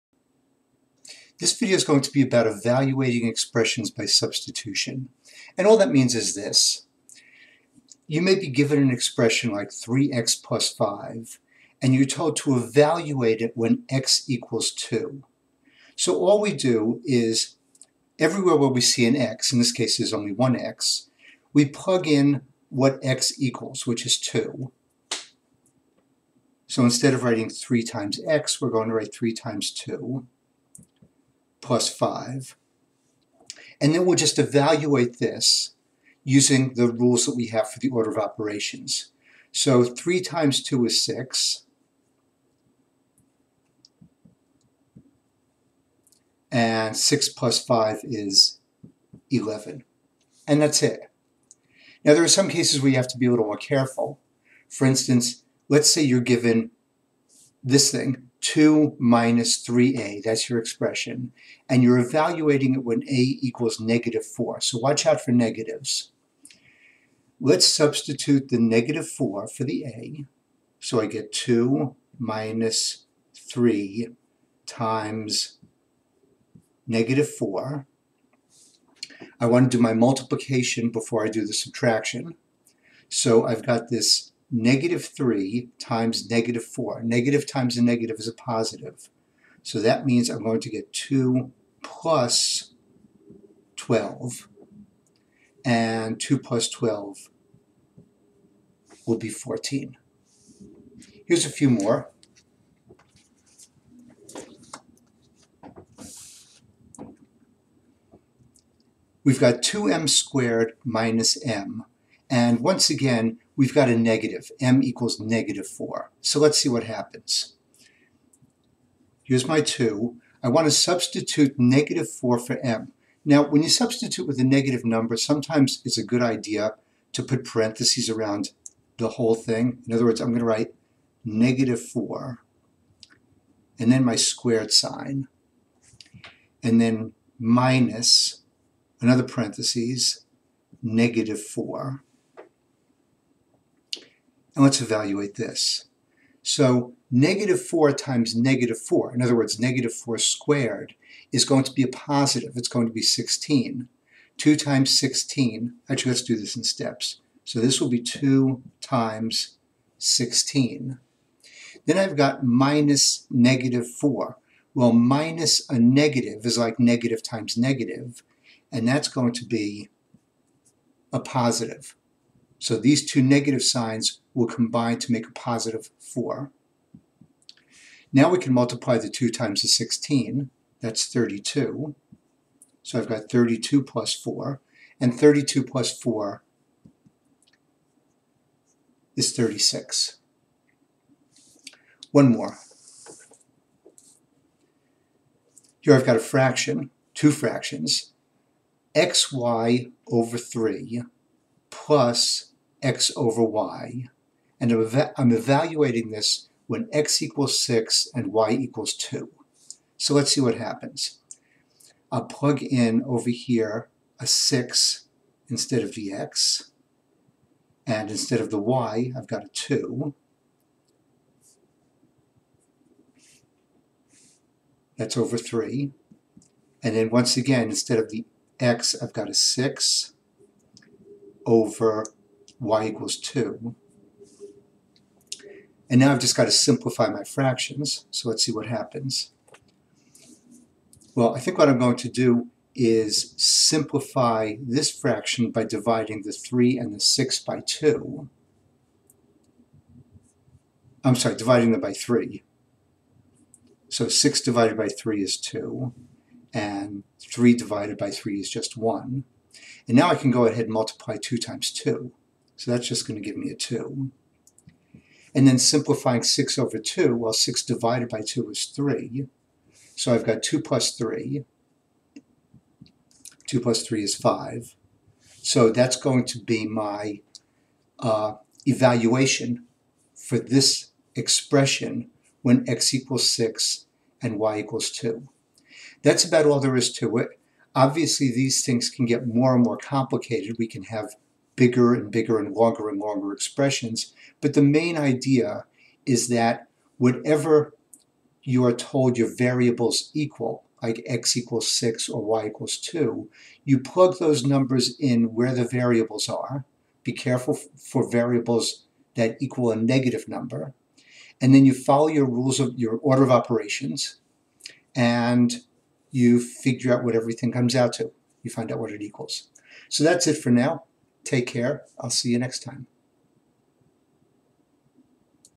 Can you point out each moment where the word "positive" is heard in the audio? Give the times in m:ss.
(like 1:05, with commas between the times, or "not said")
1:28, 2:31, 2:51, 2:55.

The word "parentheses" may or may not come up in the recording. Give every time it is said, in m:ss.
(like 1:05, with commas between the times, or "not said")
2:07, 2:19.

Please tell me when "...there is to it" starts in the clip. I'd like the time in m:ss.
4:46.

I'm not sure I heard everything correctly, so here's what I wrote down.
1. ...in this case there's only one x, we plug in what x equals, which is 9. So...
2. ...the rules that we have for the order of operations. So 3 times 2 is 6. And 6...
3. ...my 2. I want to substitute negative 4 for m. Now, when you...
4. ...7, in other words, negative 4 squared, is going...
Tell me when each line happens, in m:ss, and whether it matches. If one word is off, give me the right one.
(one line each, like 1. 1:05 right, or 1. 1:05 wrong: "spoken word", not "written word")
1. 0:19 wrong: "2", not "9"
2. 0:36 right
3. 1:59 right
4. 2:28 wrong: "4", not "7".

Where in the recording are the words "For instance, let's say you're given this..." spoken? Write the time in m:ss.
0:54.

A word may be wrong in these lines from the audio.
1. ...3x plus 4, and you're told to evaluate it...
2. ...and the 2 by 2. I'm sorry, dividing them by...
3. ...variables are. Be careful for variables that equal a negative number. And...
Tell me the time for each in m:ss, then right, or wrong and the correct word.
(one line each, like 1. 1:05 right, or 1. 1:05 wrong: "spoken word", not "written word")
1. 0:09 wrong: "5", not "4"
2. 4:06 wrong: "6", not "2"
3. 5:05 right.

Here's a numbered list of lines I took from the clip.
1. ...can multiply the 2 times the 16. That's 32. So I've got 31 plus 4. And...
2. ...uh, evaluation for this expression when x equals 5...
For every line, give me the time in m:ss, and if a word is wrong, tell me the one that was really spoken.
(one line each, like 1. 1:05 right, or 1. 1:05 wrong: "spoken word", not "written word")
1. 2:58 wrong: "32", not "31"
2. 4:37 wrong: "6", not "5".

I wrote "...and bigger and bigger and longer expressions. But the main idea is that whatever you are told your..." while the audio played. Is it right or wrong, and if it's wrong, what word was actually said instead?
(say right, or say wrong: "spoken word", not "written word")
wrong: "longer", not "bigger".